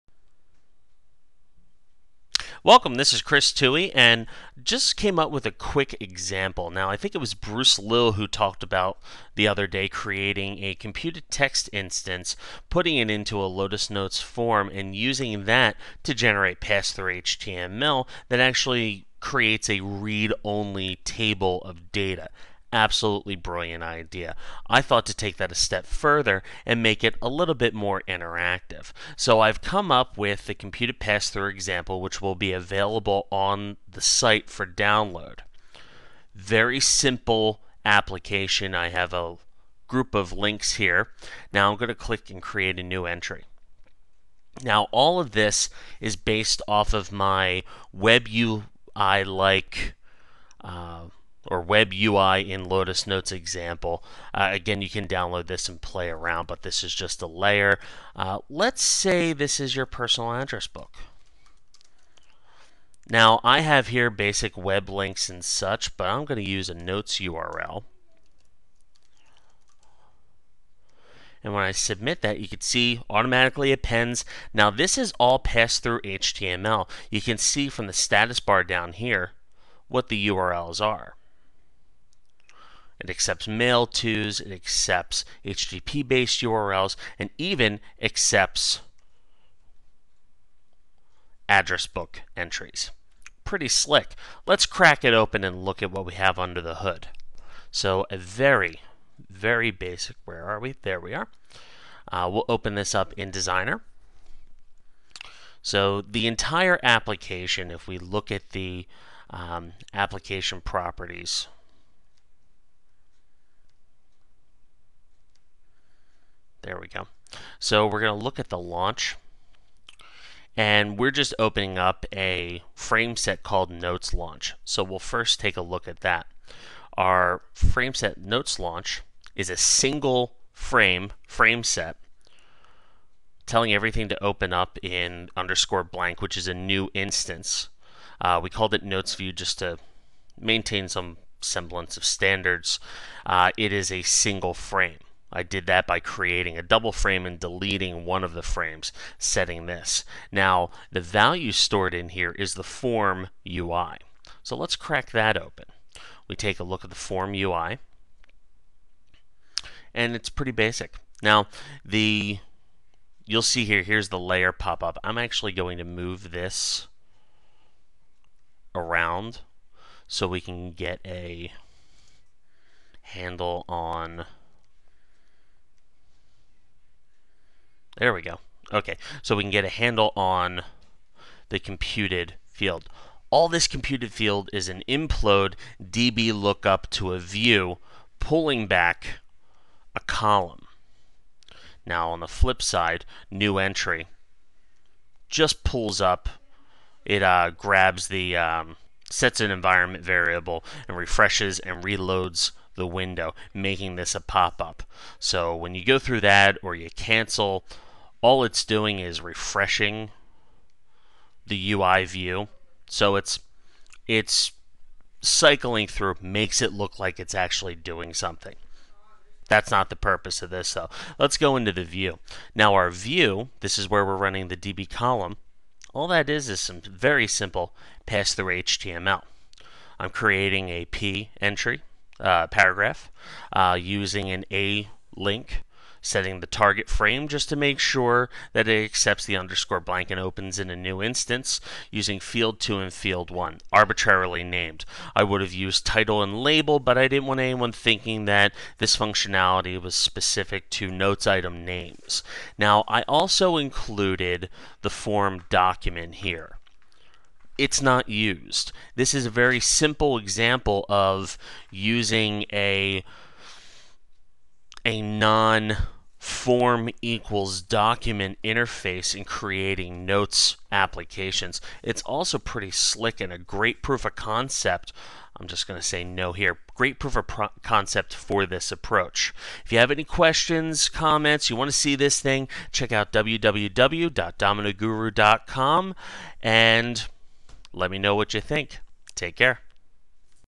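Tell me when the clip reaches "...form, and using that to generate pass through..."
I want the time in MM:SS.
00:14.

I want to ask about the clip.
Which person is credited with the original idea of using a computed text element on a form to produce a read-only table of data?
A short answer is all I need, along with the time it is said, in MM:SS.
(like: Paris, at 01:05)
Bruce Lill, at 00:07.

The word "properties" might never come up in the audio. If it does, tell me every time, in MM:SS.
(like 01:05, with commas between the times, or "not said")
01:50.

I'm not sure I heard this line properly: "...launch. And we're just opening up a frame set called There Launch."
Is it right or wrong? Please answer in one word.
wrong.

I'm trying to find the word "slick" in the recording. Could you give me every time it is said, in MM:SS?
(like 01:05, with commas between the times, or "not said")
01:33, 04:32.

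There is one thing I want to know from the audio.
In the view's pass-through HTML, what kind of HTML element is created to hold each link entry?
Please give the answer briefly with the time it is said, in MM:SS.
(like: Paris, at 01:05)
paragraph, at 03:52.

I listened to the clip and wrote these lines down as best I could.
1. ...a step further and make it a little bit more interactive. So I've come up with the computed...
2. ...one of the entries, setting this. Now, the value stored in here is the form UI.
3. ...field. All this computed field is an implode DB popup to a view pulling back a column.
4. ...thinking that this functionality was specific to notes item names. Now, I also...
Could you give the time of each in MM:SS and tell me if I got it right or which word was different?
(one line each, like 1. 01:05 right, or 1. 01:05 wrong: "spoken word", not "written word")
1. 00:25 right
2. 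02:28 wrong: "frames", not "entries"
3. 03:02 wrong: "lookup", not "popup"
4. 04:07 right.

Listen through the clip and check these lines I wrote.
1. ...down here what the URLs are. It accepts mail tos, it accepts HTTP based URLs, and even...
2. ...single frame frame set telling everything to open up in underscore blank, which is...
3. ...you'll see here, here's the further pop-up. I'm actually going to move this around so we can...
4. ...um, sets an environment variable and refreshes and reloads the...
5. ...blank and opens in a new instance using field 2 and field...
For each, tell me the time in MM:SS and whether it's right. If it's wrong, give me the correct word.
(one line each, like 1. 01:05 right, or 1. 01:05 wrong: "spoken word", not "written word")
1. 01:18 right
2. 02:09 right
3. 02:43 wrong: "layer", not "further"
4. 03:18 right
5. 03:59 right.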